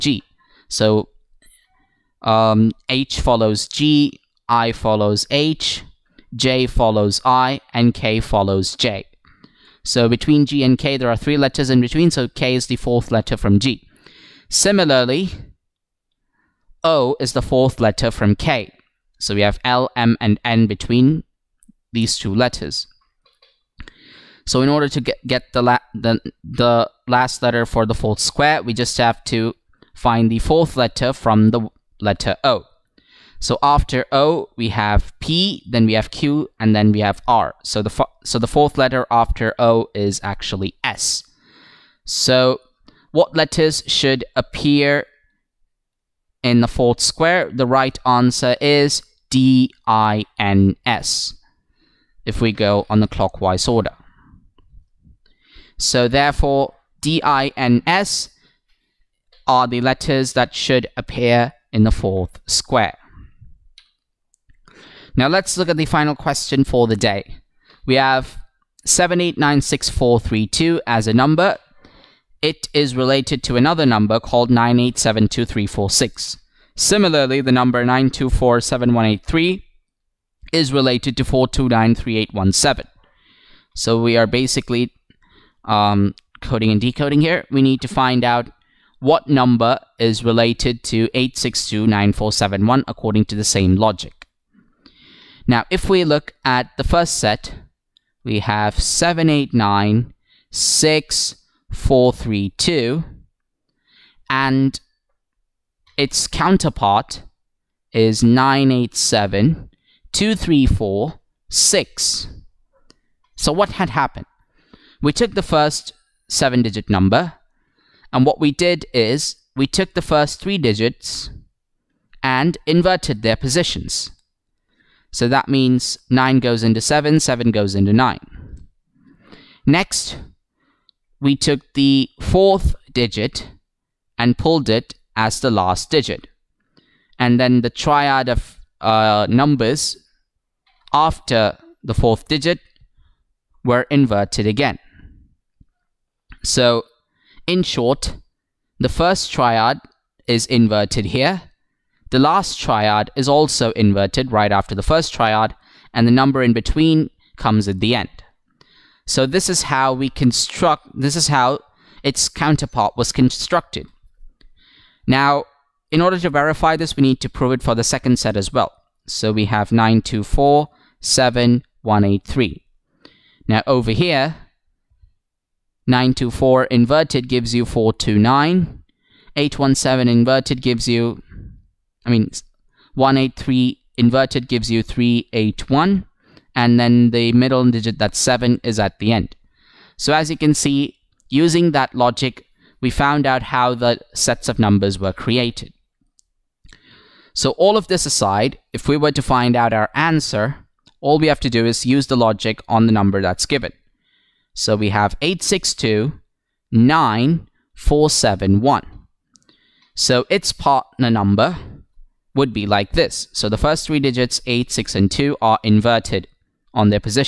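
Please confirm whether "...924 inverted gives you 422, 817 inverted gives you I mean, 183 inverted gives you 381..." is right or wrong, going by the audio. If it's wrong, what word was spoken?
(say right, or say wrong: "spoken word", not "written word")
wrong: "429", not "422".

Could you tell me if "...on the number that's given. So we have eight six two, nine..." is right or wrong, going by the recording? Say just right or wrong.
right.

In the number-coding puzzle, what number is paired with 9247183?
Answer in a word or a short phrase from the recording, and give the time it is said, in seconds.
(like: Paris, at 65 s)
4293817, at 81 s.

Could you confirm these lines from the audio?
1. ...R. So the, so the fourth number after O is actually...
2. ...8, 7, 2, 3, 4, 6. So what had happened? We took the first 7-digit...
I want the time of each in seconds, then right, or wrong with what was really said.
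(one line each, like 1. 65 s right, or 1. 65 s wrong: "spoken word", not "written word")
1. 37 s wrong: "letter", not "number"
2. 108 s right.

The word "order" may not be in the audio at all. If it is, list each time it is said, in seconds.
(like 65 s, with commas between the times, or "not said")
24 s, 53 s, 166 s.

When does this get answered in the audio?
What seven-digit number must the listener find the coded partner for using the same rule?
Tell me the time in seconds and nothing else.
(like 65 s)
91 s.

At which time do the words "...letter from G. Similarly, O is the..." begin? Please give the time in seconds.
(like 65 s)
13 s.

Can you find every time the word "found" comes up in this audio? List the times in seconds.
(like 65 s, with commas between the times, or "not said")
192 s.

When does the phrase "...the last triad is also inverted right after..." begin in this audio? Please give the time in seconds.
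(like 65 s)
152 s.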